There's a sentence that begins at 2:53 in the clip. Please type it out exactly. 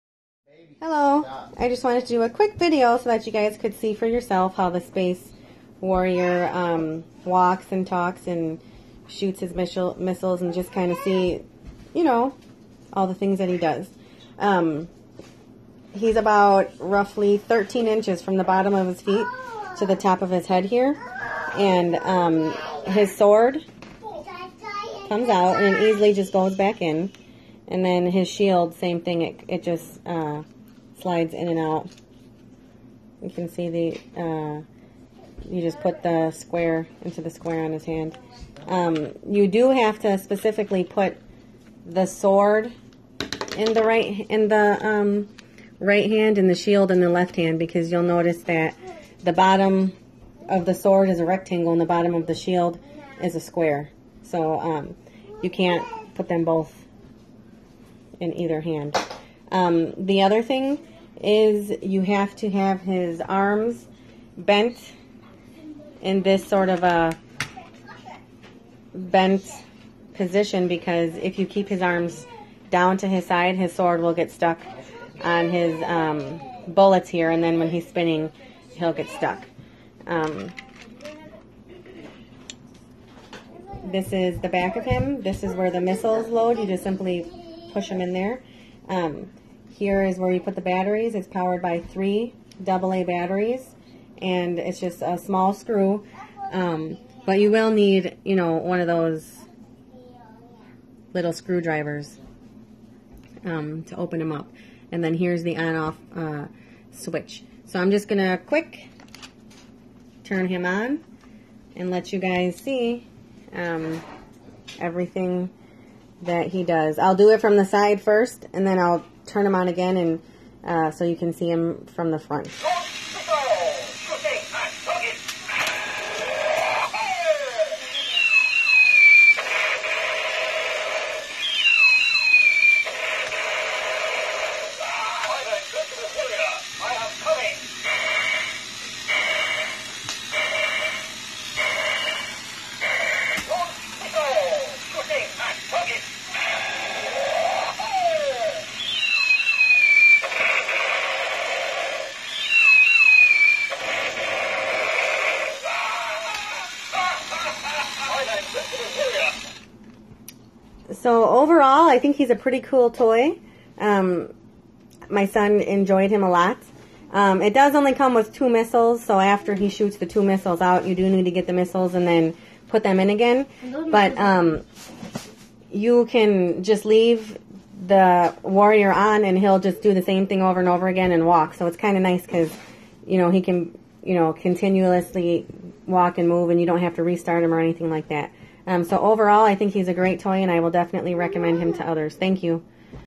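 But um, you can just leave the warrior on, and he'll just do the same thing over and over again and walk.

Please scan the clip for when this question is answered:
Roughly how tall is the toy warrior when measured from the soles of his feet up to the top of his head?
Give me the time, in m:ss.
0:17.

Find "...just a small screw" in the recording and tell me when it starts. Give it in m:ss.
1:34.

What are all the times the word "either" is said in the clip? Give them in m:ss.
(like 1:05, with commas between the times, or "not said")
0:58.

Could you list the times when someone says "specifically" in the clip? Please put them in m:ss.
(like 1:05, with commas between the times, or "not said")
0:40.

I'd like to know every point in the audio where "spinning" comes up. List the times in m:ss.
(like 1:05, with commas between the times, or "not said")
1:17.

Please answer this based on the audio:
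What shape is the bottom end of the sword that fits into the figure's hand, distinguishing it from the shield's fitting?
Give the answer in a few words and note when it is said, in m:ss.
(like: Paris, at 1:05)
Rectangle, at 0:51.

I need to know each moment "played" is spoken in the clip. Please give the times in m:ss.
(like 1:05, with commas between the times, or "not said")
not said.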